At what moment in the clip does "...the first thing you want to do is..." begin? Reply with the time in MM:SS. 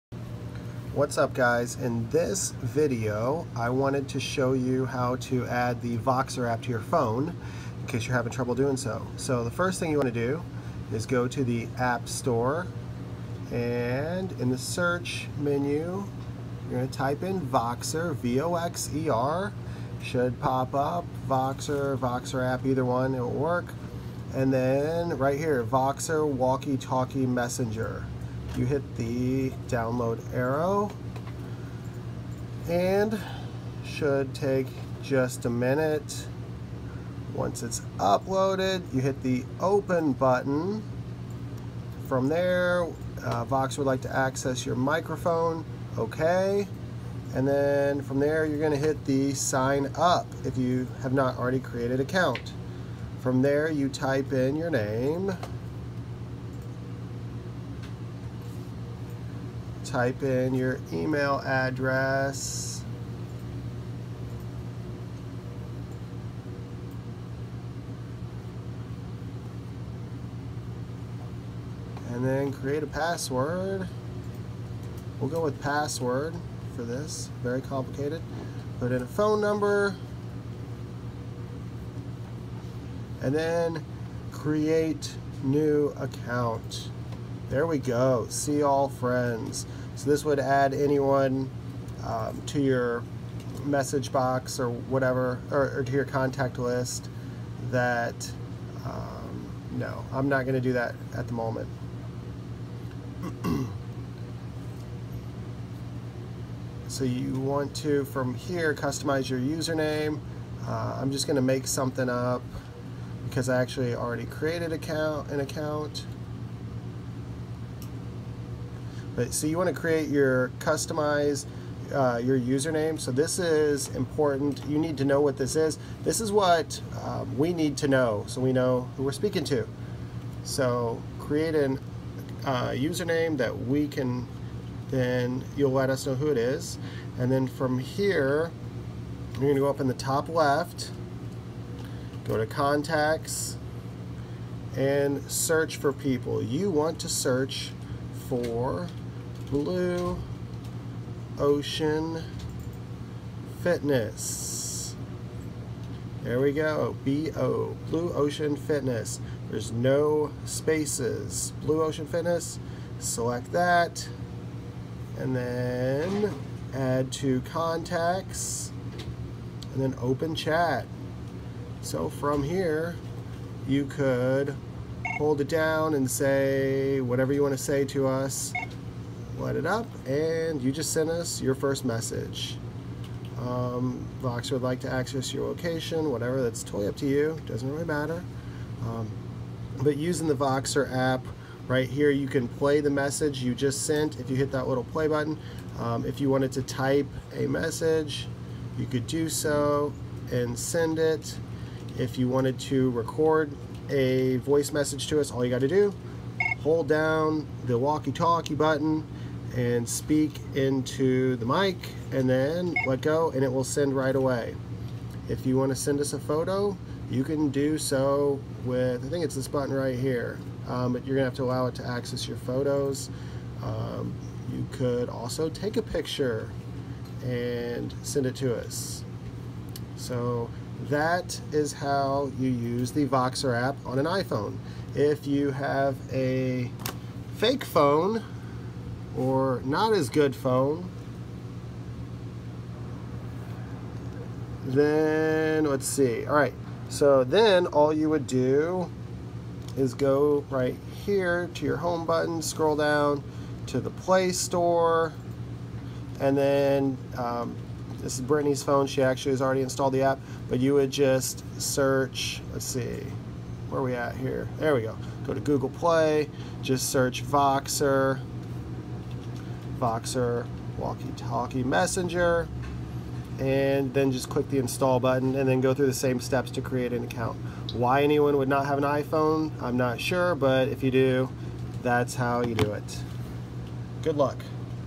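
00:09.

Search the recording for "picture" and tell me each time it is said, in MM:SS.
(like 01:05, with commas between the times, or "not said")
03:45.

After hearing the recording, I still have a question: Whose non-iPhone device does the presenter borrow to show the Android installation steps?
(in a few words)
Brittany.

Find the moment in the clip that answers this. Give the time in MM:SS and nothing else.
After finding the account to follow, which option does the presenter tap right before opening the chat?
02:46.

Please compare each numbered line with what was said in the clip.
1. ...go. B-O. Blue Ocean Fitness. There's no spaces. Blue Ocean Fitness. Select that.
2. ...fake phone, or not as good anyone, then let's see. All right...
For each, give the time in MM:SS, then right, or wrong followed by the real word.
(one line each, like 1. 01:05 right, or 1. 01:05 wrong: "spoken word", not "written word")
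1. 02:36 right
2. 03:57 wrong: "phone", not "anyone".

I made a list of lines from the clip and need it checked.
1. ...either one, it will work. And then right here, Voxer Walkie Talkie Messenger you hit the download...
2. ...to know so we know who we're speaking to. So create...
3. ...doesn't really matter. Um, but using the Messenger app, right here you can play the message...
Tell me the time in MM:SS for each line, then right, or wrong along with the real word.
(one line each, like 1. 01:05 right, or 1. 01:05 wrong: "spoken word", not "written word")
1. 00:22 right
2. 02:07 right
3. 03:07 wrong: "Voxer", not "Messenger".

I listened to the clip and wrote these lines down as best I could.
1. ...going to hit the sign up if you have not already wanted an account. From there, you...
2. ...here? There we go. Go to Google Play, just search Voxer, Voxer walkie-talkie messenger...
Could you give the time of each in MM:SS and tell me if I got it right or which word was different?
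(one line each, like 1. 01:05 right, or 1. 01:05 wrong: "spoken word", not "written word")
1. 00:48 wrong: "created", not "wanted"
2. 04:24 right.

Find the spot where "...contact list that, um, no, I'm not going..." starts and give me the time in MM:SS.
01:36.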